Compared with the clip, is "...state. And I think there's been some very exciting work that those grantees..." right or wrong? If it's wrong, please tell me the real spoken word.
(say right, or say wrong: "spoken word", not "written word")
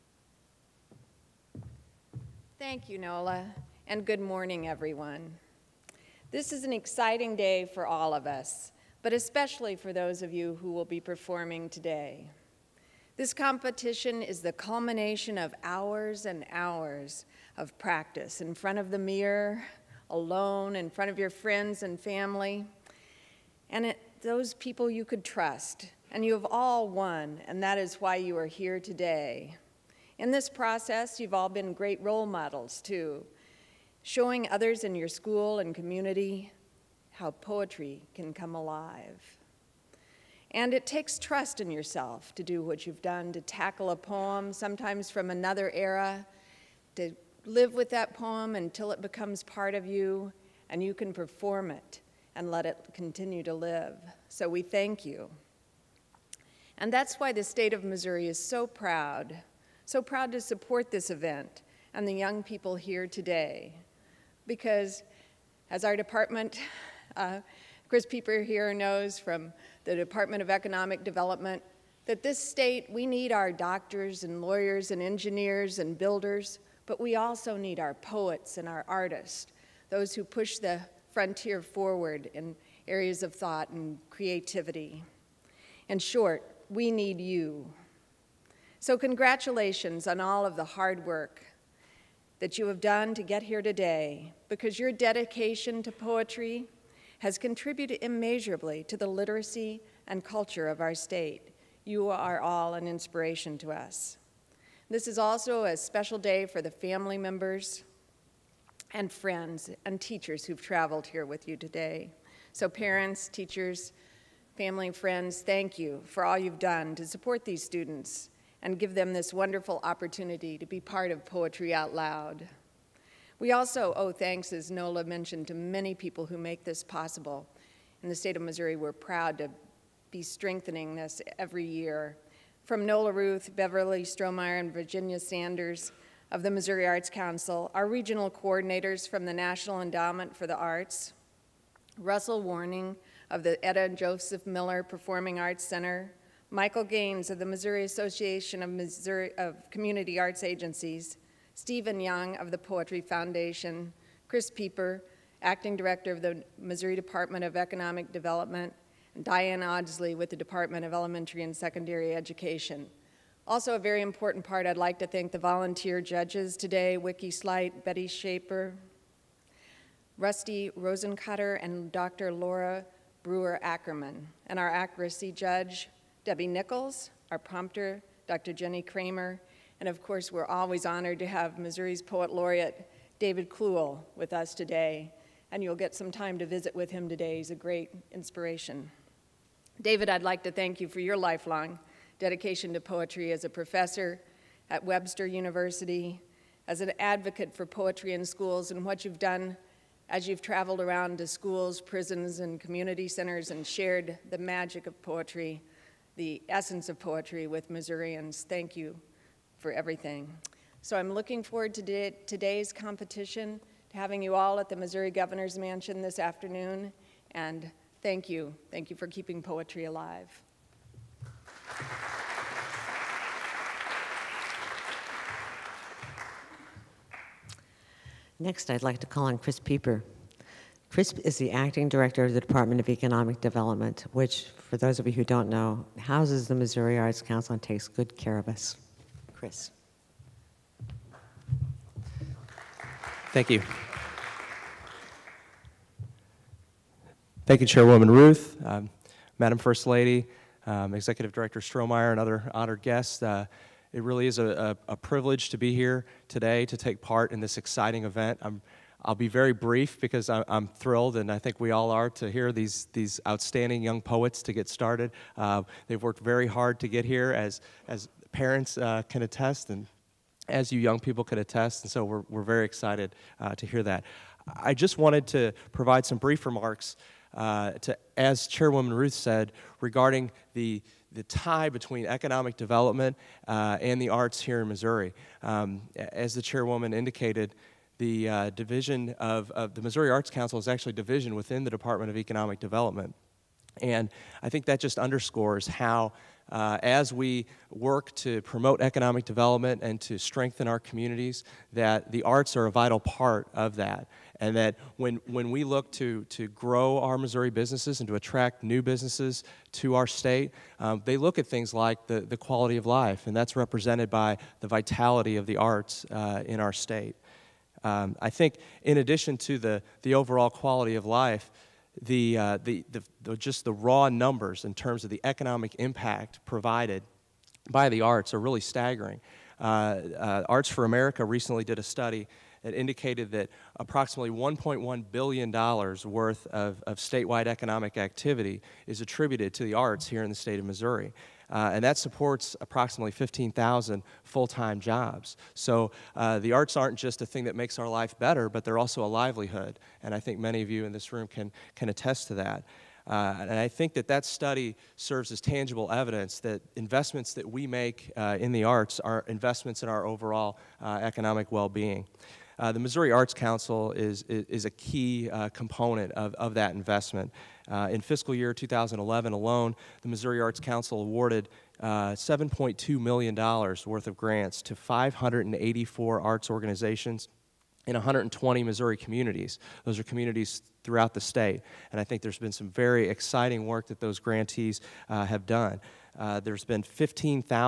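right.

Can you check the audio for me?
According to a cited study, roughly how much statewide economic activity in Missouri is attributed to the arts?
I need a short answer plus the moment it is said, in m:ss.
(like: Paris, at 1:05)
$1.1 billion, at 5:34.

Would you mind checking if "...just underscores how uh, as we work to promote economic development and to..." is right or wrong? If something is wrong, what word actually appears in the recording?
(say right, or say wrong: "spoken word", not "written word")
right.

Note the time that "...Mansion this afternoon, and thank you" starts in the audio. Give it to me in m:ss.
3:35.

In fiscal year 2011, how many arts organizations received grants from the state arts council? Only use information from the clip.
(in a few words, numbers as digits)
584.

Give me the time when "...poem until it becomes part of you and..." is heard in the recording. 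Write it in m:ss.
0:48.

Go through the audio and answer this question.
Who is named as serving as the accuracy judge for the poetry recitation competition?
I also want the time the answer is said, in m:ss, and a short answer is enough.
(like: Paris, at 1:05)
Debbie Nichols, at 2:56.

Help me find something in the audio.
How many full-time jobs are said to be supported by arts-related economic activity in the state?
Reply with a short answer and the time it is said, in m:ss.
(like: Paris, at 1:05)
15,000, at 5:43.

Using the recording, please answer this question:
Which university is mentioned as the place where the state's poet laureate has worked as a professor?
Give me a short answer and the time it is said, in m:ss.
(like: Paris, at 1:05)
Webster University, at 3:14.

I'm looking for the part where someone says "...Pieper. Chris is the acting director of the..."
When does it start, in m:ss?
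3:49.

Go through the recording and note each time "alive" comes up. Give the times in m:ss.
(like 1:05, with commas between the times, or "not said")
0:38, 3:39.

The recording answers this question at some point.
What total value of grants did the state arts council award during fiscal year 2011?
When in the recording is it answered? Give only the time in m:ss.
6:12.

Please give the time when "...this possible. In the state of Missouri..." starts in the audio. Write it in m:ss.
2:06.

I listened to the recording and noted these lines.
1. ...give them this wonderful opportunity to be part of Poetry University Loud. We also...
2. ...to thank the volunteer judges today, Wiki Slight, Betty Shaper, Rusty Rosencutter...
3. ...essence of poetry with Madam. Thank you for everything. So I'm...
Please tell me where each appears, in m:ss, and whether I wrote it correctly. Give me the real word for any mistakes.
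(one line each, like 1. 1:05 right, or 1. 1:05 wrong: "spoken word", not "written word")
1. 1:58 wrong: "Out", not "University"
2. 2:44 right
3. 3:26 wrong: "Missourians", not "Madam".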